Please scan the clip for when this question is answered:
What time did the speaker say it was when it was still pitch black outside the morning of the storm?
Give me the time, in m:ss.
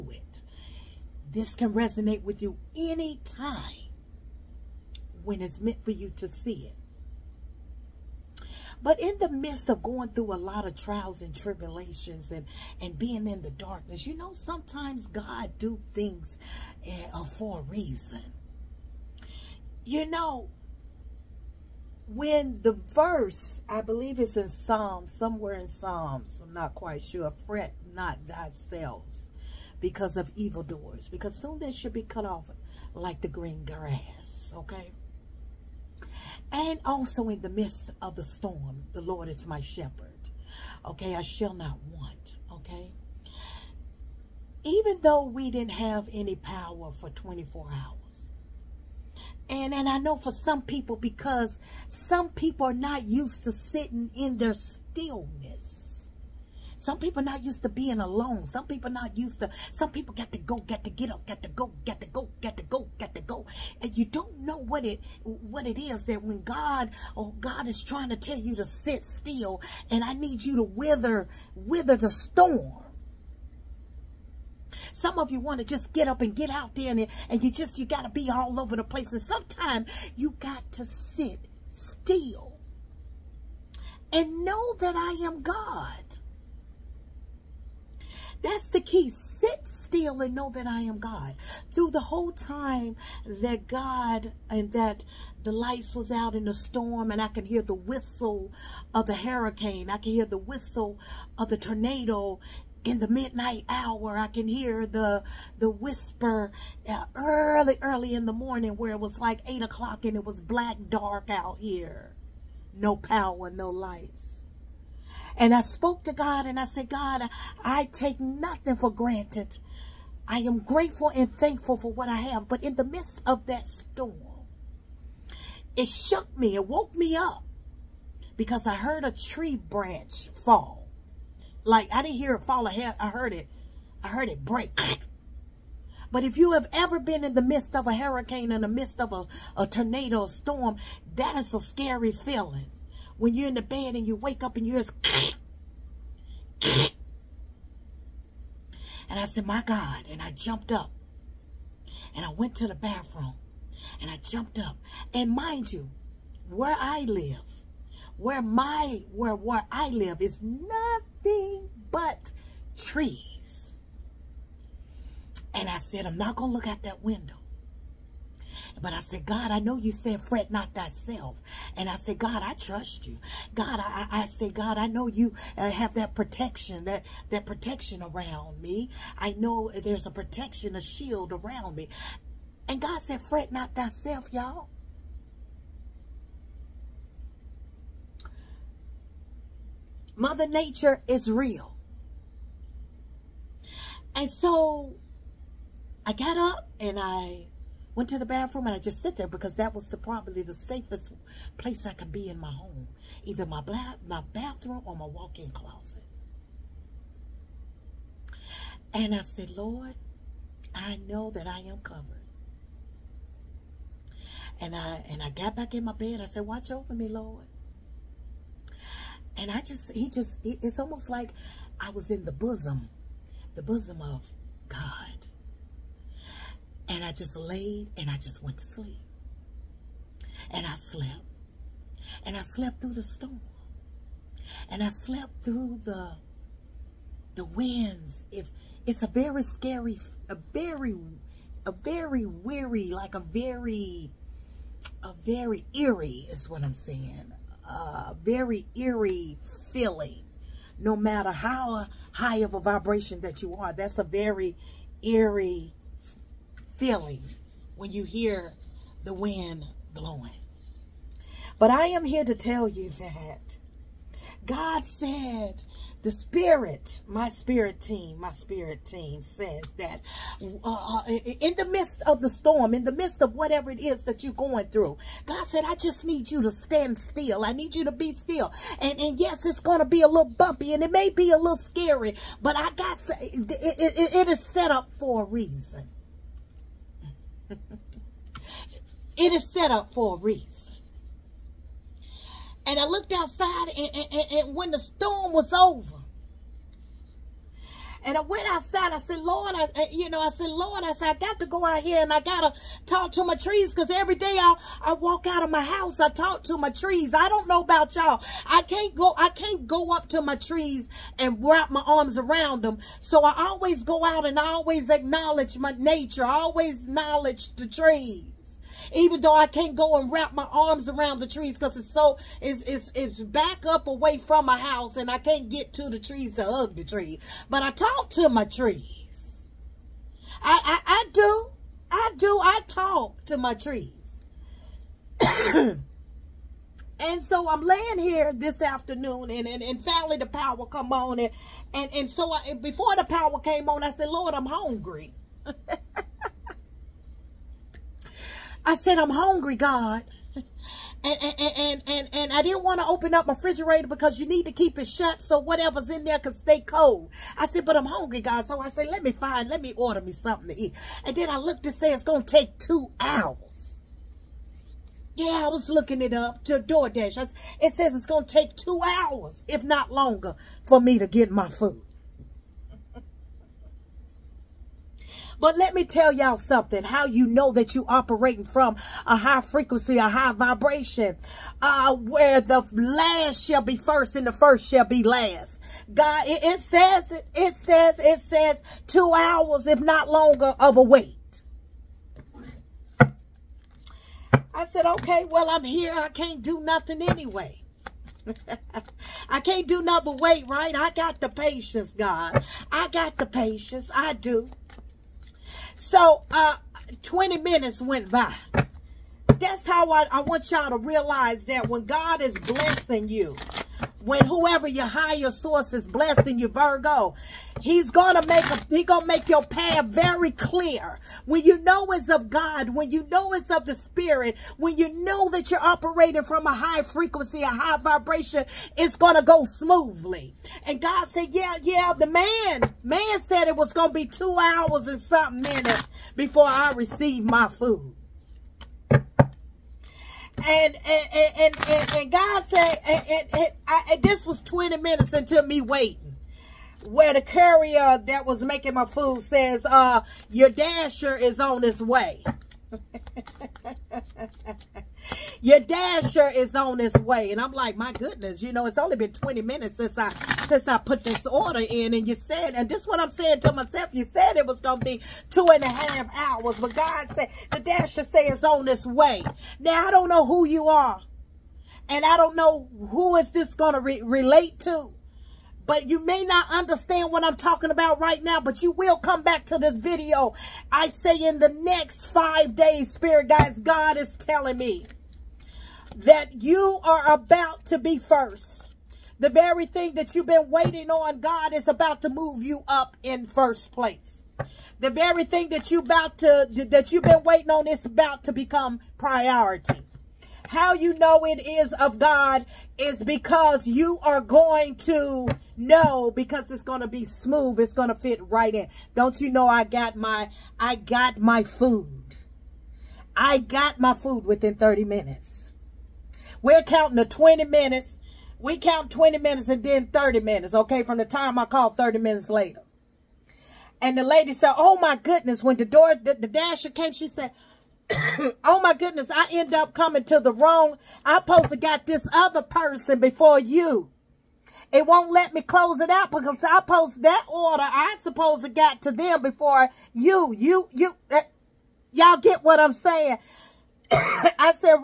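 1:49.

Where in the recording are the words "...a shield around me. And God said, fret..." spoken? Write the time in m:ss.
3:00.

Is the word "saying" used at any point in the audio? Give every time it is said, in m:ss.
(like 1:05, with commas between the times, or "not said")
4:06, 7:43, 9:02.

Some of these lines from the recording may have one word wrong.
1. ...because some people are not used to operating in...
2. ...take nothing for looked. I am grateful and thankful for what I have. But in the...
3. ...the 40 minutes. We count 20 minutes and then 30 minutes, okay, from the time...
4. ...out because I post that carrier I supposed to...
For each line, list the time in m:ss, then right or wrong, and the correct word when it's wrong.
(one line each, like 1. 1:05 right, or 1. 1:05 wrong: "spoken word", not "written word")
1. 0:50 wrong: "sitting", not "operating"
2. 1:57 wrong: "granted", not "looked"
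3. 8:36 wrong: "20", not "40"
4. 8:55 wrong: "order", not "carrier".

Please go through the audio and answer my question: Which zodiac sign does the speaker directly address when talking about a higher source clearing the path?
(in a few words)
Virgo.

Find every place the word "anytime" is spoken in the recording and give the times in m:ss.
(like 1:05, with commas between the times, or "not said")
0:02.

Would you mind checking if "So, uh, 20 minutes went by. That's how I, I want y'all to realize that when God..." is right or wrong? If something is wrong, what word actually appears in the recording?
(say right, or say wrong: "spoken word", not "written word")
right.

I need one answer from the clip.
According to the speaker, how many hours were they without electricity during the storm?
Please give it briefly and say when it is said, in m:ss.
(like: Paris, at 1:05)
24, at 0:47.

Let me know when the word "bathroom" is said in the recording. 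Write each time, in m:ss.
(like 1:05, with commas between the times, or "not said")
2:32, 3:18, 3:24.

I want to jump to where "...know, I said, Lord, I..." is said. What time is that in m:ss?
5:00.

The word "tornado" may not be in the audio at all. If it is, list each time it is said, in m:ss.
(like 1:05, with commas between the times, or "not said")
1:41, 2:19.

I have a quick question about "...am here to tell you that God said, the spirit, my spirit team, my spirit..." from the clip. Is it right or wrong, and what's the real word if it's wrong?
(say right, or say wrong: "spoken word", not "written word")
right.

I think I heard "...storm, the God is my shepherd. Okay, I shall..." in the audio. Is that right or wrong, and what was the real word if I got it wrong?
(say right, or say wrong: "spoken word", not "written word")
wrong: "Lord", not "God".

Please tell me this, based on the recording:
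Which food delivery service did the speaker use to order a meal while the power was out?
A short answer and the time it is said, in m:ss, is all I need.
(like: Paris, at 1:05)
DoorDash, at 6:06.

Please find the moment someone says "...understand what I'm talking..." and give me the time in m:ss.
7:56.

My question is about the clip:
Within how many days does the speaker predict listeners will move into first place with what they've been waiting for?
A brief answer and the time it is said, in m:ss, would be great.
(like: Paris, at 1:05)
5, at 8:02.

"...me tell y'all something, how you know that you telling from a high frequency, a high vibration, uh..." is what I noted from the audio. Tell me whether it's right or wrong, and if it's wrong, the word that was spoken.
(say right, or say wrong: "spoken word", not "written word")
wrong: "operating", not "telling".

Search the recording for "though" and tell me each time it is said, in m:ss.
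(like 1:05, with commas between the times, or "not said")
0:45, 5:19.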